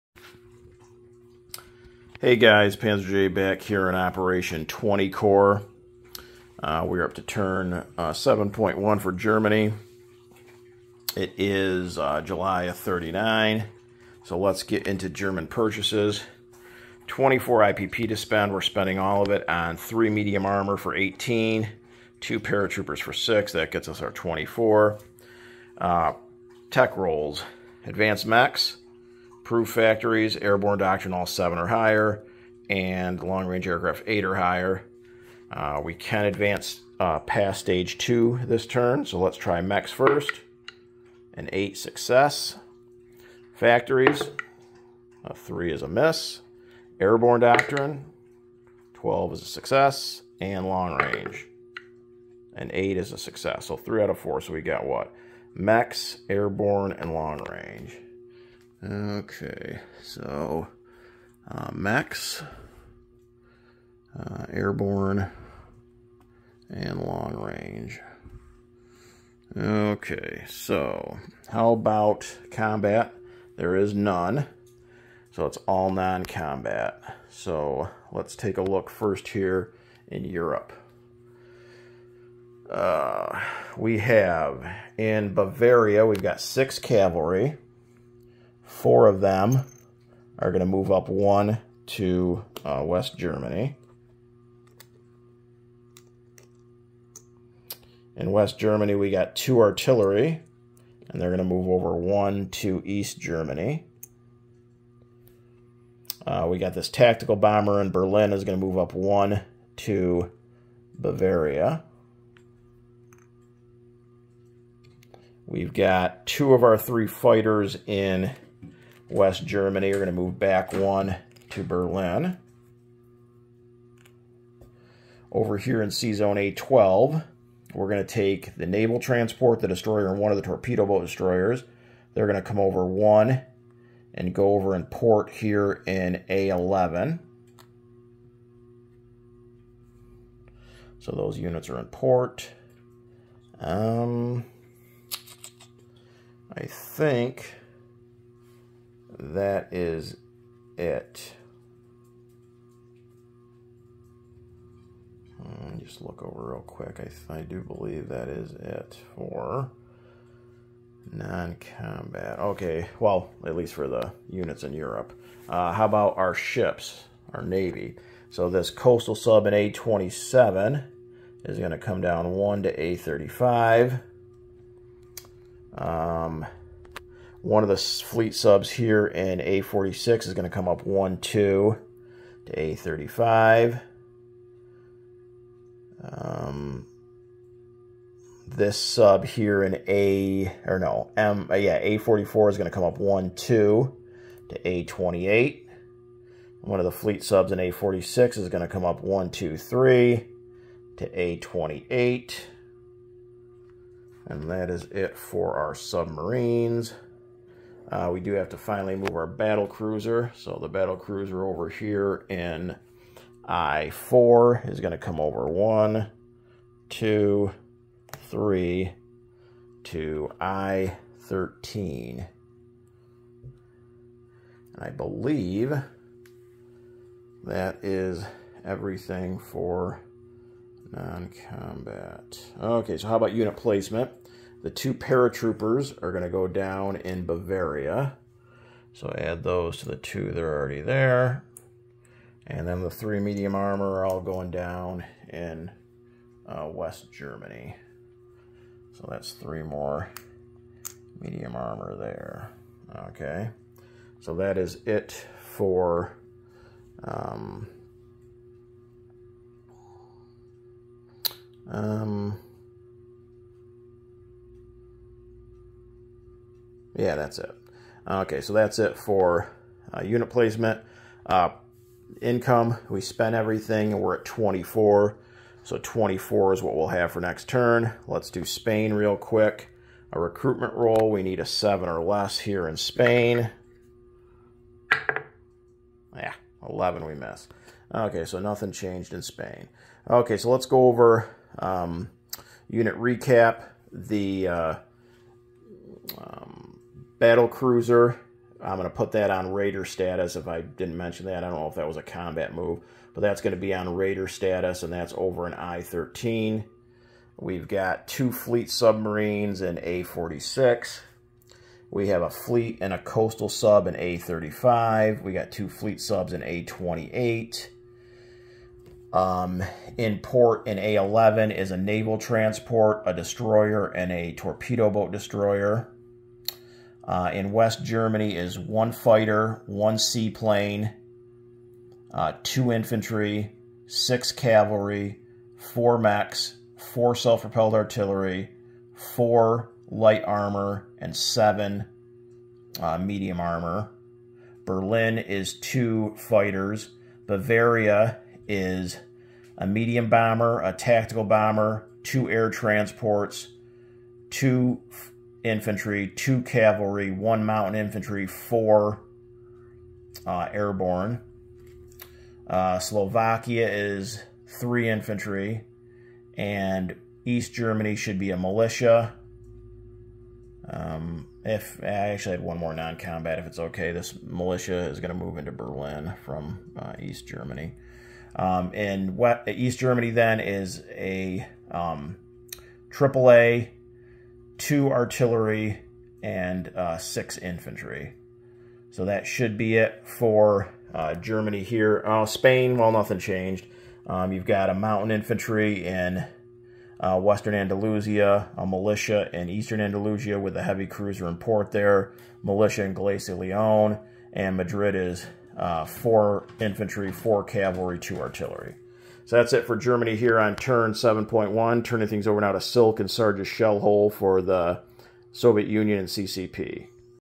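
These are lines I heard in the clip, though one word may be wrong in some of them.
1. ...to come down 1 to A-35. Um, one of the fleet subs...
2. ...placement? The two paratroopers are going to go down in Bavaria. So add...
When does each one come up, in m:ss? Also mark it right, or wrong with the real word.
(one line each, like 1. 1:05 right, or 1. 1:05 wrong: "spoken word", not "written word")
1. 2:51 right
2. 3:53 right.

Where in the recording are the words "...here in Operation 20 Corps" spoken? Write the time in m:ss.
0:03.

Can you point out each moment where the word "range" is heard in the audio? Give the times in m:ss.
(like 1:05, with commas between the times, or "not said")
0:33, 0:50, 0:57, 1:07.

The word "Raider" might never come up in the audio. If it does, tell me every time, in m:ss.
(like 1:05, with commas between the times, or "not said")
4:59, 5:03.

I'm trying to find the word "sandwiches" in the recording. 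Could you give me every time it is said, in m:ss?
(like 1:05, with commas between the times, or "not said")
not said.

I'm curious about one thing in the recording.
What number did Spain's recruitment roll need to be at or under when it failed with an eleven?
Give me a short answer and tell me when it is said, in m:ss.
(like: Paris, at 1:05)
7, at 4:41.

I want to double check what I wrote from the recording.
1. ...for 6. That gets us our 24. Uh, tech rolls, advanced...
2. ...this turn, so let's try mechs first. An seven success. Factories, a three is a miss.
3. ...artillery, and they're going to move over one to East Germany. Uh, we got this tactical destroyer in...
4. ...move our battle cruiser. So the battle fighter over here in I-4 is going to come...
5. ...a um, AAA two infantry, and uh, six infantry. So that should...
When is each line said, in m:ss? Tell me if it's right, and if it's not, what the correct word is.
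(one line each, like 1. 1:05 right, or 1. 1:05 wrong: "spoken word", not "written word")
1. 0:23 right
2. 0:38 wrong: "eight", not "seven"
3. 1:39 wrong: "bomber", not "destroyer"
4. 3:28 wrong: "cruiser", not "fighter"
5. 6:20 wrong: "artillery", not "infantry".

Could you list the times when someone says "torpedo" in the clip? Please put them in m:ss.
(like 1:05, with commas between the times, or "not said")
2:10, 5:24.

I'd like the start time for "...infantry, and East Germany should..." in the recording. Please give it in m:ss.
6:04.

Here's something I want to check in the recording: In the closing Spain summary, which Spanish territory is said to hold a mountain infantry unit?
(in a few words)
western Andalusia.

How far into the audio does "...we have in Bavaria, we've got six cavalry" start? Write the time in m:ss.
1:23.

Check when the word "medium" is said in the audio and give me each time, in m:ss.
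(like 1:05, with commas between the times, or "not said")
0:20, 4:03, 4:11, 5:42, 5:49.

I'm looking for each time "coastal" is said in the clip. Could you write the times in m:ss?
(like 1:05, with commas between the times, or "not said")
2:48, 5:12.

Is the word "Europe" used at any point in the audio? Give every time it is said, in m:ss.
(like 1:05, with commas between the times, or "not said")
1:20, 2:44.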